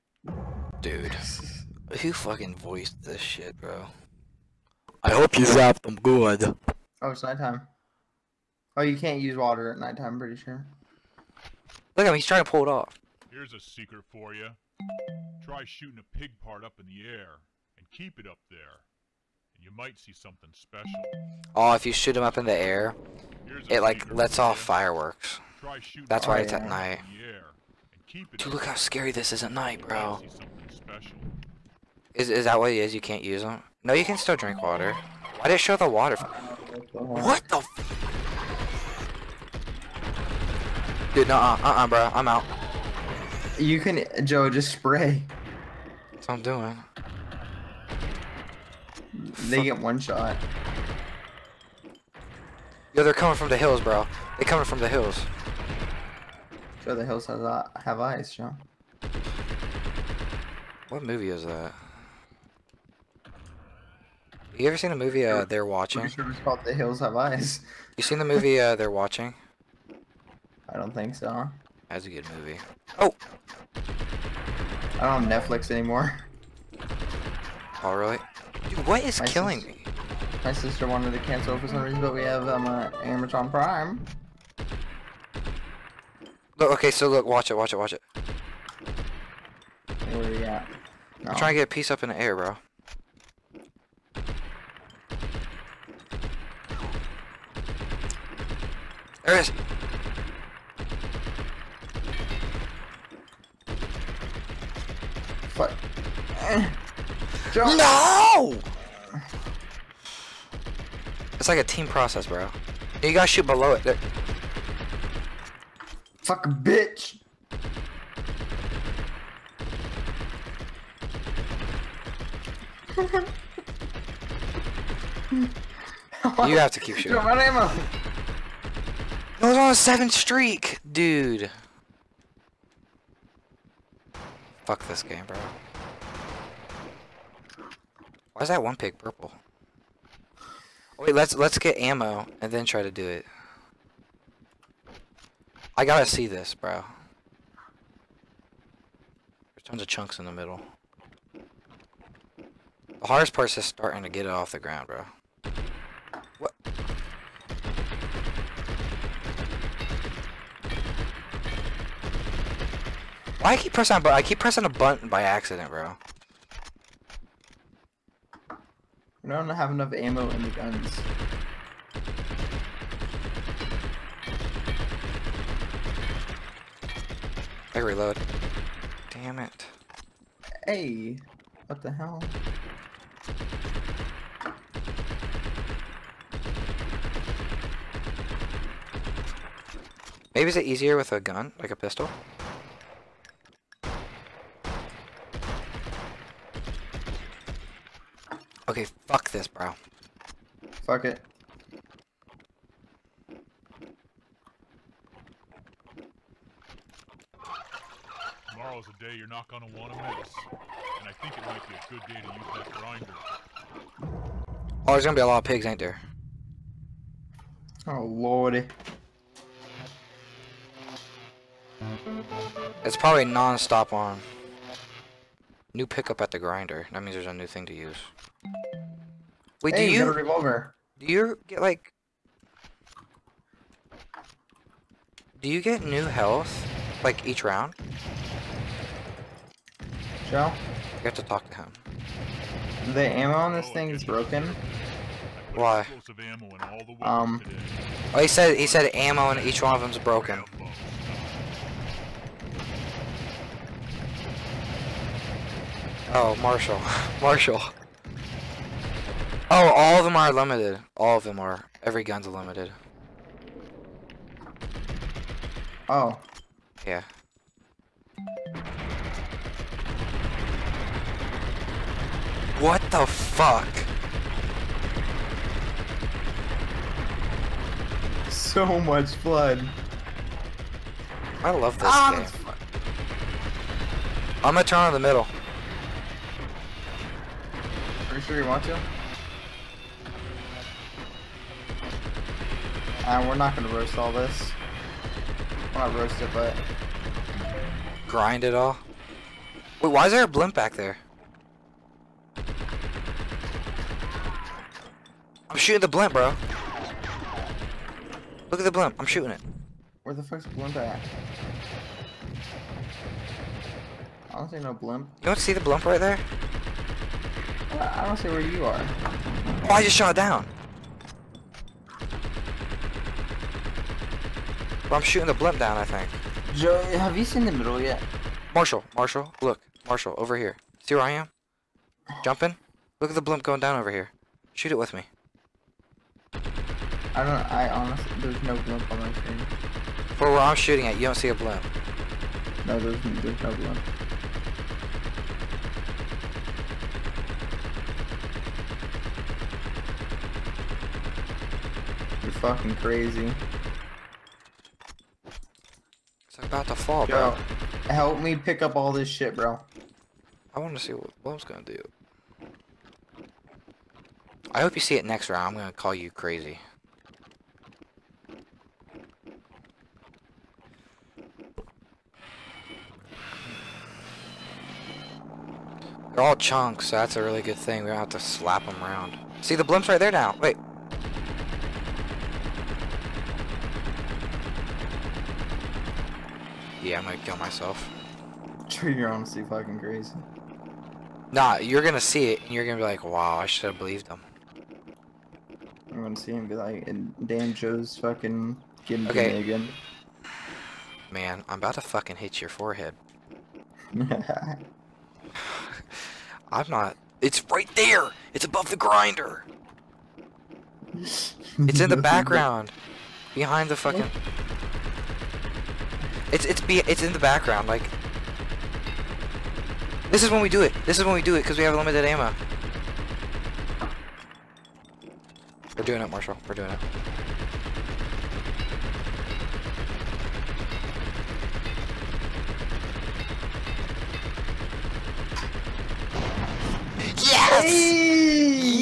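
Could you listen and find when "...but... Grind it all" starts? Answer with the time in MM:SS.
04:56.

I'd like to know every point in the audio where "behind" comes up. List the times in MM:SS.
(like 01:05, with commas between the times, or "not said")
06:53.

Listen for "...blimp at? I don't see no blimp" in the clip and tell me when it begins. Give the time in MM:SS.
05:10.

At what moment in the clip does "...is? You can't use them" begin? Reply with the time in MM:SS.
00:32.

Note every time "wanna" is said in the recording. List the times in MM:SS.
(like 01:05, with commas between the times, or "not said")
03:29.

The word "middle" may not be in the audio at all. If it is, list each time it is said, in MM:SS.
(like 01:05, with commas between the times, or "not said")
02:30, 04:44, 05:27.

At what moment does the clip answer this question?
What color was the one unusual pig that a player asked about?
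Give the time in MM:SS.
02:18.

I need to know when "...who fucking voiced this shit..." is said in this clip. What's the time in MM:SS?
00:01.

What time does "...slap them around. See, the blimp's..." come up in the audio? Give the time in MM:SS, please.
06:18.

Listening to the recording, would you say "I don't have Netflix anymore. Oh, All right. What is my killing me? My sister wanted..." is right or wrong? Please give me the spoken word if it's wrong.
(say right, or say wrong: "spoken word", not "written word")
right.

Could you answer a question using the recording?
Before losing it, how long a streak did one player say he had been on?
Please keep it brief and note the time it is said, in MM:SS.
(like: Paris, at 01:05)
7, at 02:09.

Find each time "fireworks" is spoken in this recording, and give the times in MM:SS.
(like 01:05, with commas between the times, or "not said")
00:24.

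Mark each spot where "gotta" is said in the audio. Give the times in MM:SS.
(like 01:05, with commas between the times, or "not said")
01:53, 02:25.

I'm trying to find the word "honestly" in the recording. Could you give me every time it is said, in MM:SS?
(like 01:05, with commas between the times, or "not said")
05:37, 06:29.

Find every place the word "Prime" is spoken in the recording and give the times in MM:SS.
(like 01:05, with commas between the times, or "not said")
01:23.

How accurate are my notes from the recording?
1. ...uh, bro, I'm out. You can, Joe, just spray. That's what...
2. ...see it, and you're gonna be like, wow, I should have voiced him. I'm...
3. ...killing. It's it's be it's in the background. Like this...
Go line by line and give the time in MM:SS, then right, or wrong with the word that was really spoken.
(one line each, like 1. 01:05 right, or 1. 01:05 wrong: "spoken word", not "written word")
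1. 00:41 right
2. 06:31 wrong: "believed", not "voiced"
3. 06:53 wrong: "fucking", not "killing".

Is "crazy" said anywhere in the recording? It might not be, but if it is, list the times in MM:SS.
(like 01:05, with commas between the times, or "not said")
05:52, 06:06, 06:29.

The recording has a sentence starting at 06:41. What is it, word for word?
Man, I'm about to fucking hit your forehead.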